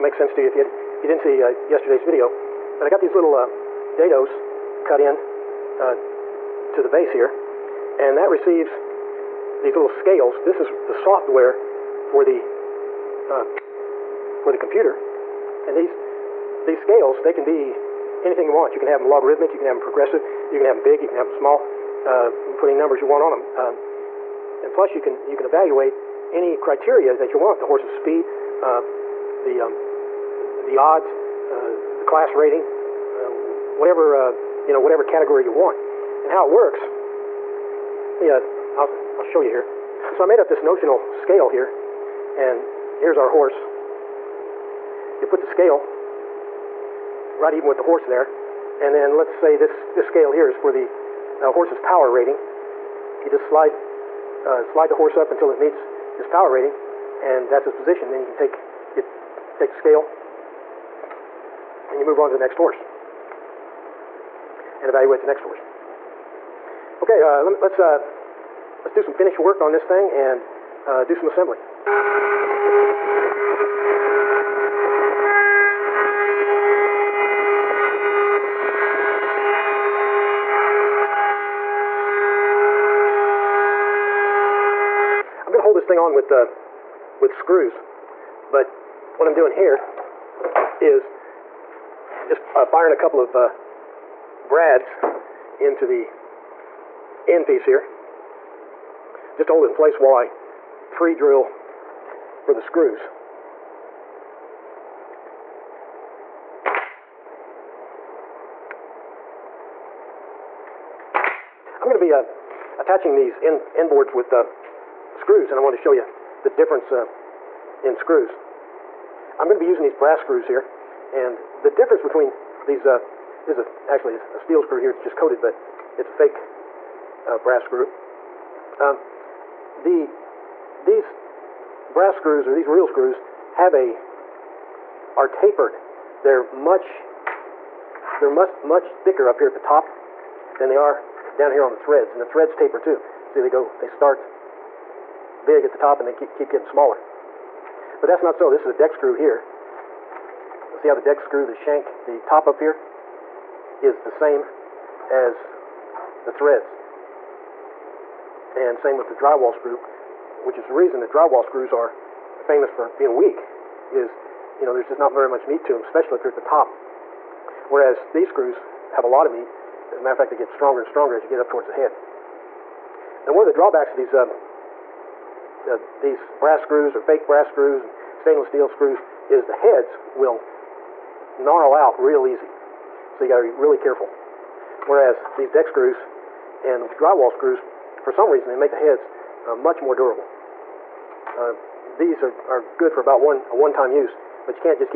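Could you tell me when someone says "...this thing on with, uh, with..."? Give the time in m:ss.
1:25.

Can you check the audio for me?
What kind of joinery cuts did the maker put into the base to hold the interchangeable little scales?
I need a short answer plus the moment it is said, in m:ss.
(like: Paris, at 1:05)
dados, at 0:03.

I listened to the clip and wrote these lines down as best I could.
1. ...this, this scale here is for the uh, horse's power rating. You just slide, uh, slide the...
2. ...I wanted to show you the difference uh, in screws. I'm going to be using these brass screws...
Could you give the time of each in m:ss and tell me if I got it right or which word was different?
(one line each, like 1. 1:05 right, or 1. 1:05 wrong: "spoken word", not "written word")
1. 0:49 right
2. 1:55 right.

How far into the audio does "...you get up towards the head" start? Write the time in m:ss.
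2:51.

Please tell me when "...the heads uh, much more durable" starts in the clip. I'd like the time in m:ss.
3:08.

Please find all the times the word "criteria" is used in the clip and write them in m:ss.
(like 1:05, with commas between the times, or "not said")
0:26.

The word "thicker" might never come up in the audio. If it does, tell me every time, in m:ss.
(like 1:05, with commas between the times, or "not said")
2:19.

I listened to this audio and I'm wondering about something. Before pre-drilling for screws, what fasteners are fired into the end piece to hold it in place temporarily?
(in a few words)
brads.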